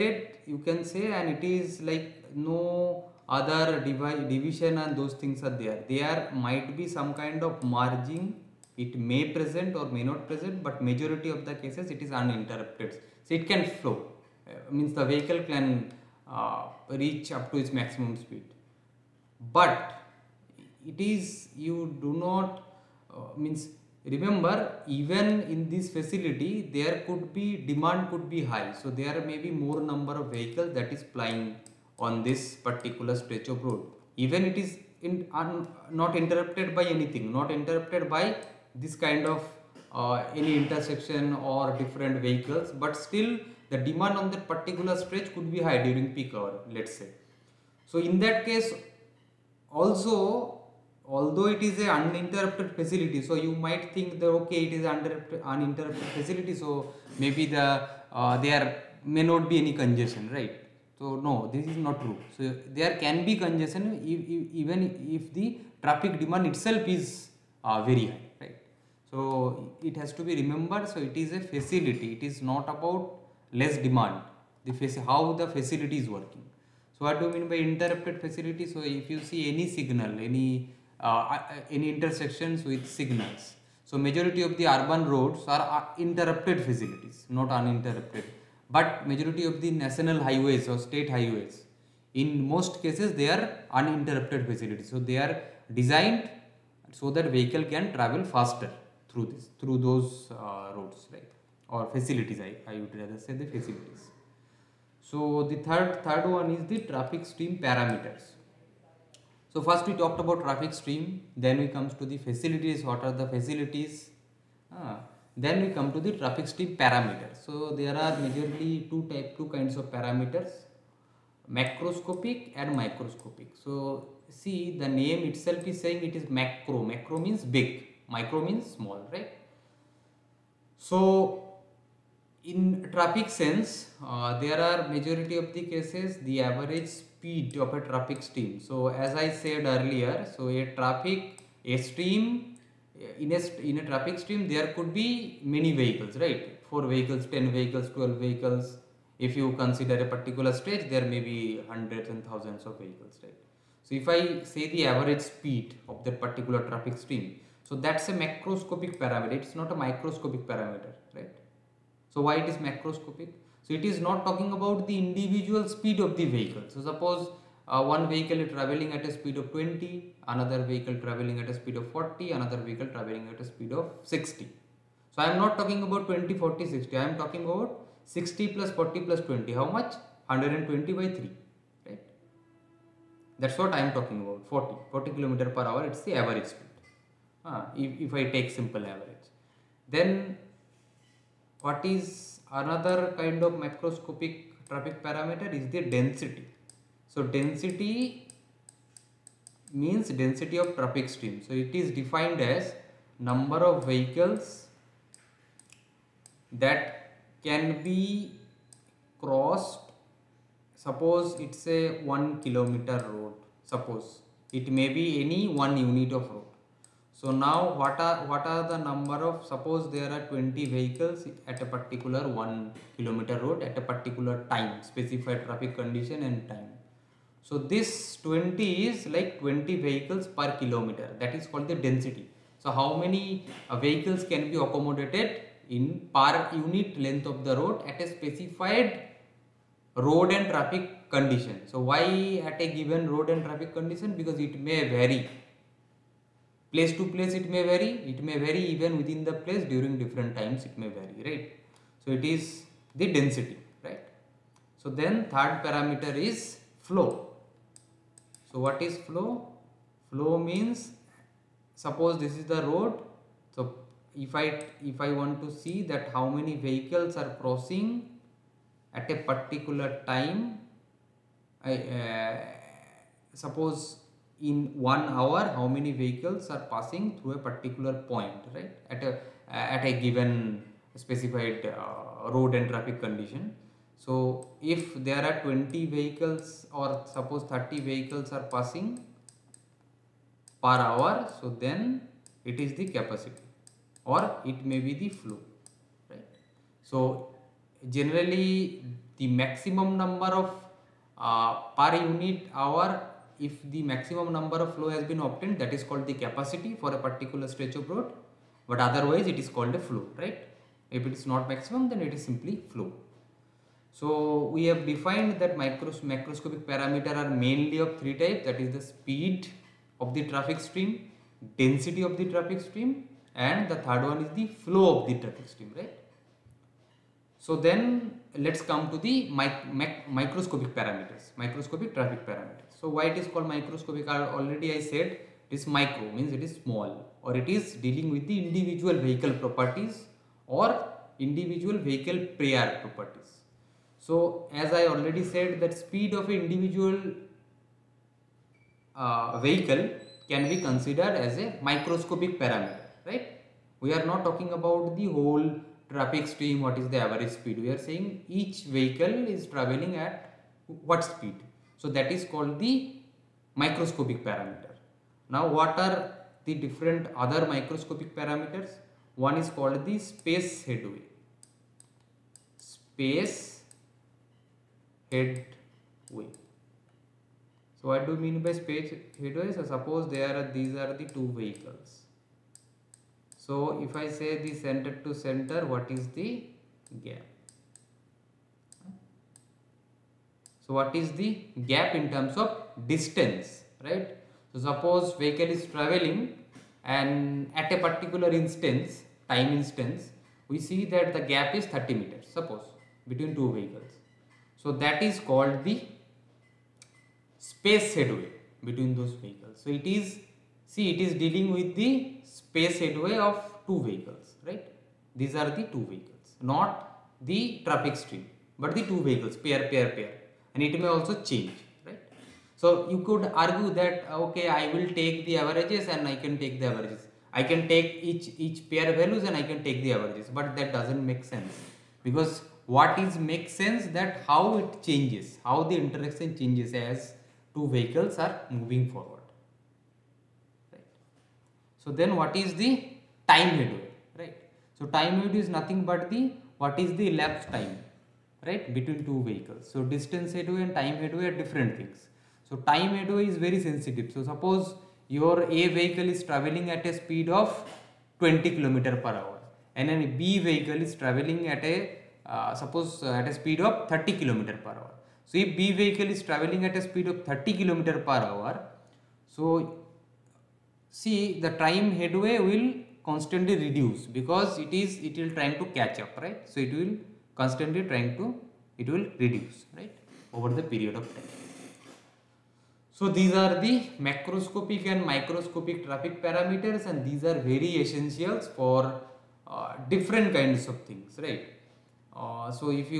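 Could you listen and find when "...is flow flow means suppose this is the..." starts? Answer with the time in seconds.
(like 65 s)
258 s.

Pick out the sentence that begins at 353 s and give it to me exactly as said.
We are not talking about the whole traffic stream, what is the average speed.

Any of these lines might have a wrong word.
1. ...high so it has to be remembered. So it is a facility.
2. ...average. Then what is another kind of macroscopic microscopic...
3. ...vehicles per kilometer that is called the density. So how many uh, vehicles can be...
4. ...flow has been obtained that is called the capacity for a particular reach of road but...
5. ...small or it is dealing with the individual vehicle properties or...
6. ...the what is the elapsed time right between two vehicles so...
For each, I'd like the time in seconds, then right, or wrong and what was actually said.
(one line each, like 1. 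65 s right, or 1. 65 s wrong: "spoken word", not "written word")
1. 68 s right
2. 188 s wrong: "traffic", not "microscopic"
3. 229 s right
4. 304 s wrong: "stretch", not "reach"
5. 336 s right
6. 446 s right.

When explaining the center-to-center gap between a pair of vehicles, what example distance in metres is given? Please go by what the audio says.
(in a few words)
30 meters.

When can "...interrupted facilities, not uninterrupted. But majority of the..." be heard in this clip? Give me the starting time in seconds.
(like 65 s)
86 s.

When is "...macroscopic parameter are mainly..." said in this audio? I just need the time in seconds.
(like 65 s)
316 s.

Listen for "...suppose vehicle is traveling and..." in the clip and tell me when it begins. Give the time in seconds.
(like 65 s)
394 s.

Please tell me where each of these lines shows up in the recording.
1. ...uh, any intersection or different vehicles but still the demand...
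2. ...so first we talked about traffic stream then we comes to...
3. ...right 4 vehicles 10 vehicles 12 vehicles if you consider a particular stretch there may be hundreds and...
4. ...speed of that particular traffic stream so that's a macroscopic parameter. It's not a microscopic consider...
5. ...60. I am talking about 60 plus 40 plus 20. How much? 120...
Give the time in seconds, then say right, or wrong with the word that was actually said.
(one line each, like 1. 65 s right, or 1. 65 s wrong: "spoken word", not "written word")
1. 39 s right
2. 109 s right
3. 146 s right
4. 155 s wrong: "parameter", not "consider"
5. 176 s right.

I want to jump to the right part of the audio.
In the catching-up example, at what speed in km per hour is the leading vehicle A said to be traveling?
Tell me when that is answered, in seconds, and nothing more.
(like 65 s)
457 s.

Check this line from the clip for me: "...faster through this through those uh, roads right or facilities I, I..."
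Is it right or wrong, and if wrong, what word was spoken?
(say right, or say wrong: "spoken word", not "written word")
right.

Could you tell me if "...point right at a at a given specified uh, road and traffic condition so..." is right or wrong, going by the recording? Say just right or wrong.
right.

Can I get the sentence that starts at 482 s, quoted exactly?
So these are the macroscopic and microscopic traffic parameters and these are very essentials for uh, different kinds of things right.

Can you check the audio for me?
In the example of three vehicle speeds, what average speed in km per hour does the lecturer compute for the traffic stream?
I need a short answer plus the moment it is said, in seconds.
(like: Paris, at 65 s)
40, at 184 s.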